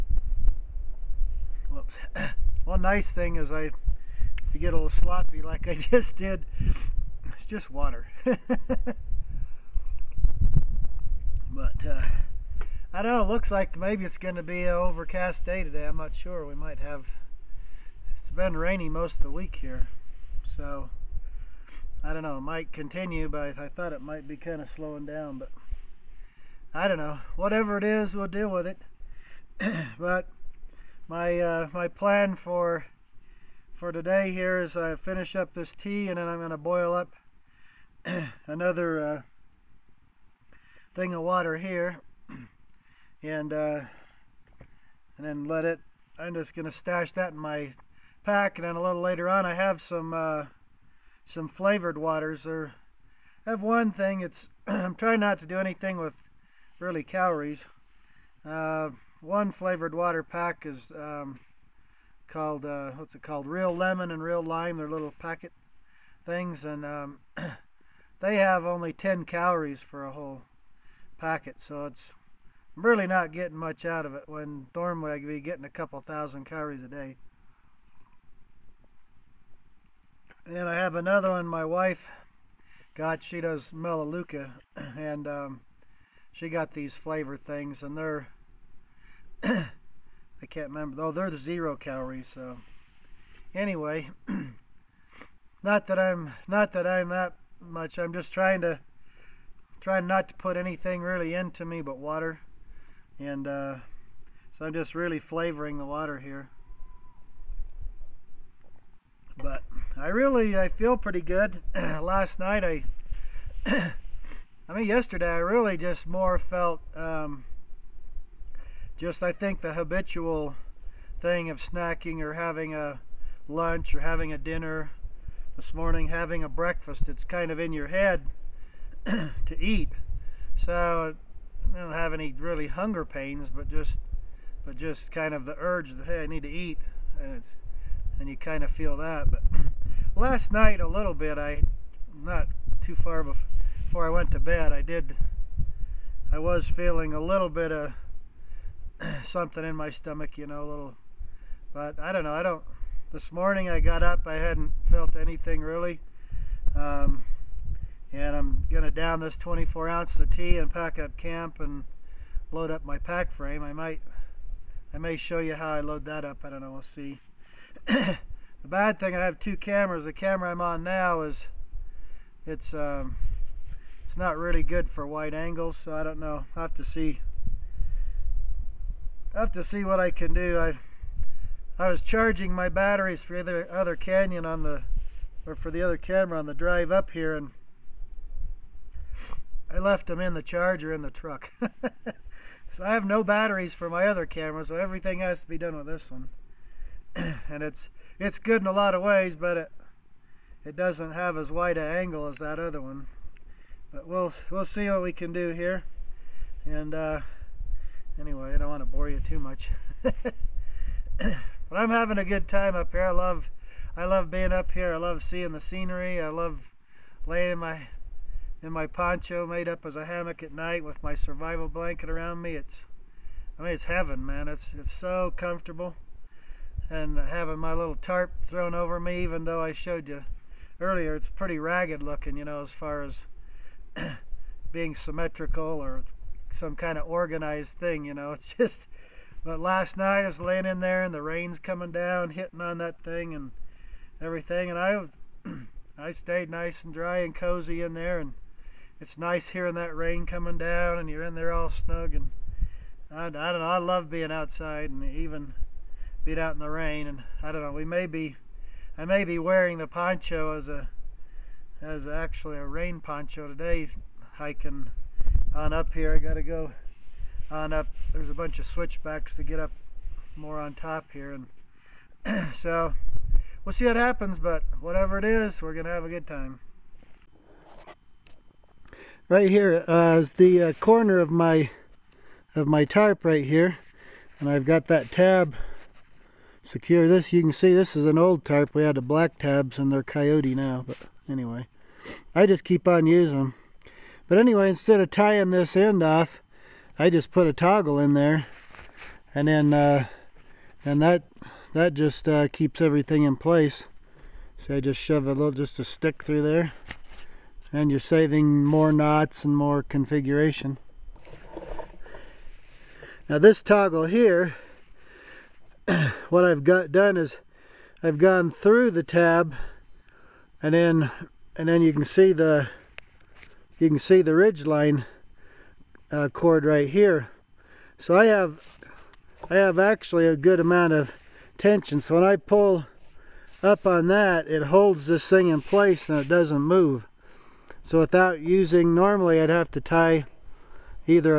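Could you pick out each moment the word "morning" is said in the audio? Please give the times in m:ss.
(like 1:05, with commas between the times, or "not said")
2:05, 2:33.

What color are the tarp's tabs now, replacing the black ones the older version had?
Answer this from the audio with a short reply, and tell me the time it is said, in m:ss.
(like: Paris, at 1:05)
Coyote, at 4:50.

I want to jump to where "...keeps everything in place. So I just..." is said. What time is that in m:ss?
5:02.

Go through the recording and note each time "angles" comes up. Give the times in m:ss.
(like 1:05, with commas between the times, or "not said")
2:55, 3:21.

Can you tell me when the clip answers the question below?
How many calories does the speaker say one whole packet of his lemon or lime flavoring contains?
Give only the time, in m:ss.
1:08.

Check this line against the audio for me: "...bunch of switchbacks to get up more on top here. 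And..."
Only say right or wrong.
right.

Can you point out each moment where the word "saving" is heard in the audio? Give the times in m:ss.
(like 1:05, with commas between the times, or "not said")
5:08.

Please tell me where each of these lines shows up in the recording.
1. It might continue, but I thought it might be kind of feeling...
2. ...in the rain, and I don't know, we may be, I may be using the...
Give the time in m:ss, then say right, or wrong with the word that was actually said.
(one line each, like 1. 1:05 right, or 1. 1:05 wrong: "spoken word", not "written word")
1. 0:22 wrong: "slowing", not "feeling"
2. 4:16 wrong: "wearing", not "using".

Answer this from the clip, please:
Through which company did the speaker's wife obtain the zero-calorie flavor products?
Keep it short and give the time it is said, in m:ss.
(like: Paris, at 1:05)
Melaleuca, at 1:23.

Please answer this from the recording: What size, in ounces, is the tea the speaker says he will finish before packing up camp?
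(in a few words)
24 ounces.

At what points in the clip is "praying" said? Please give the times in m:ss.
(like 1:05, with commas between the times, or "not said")
not said.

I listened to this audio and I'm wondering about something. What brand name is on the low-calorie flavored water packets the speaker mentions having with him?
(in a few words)
Real Lemon and Real Lime.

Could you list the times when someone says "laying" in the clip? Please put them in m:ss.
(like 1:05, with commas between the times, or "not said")
3:37, 4:00.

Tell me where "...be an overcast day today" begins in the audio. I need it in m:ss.
0:14.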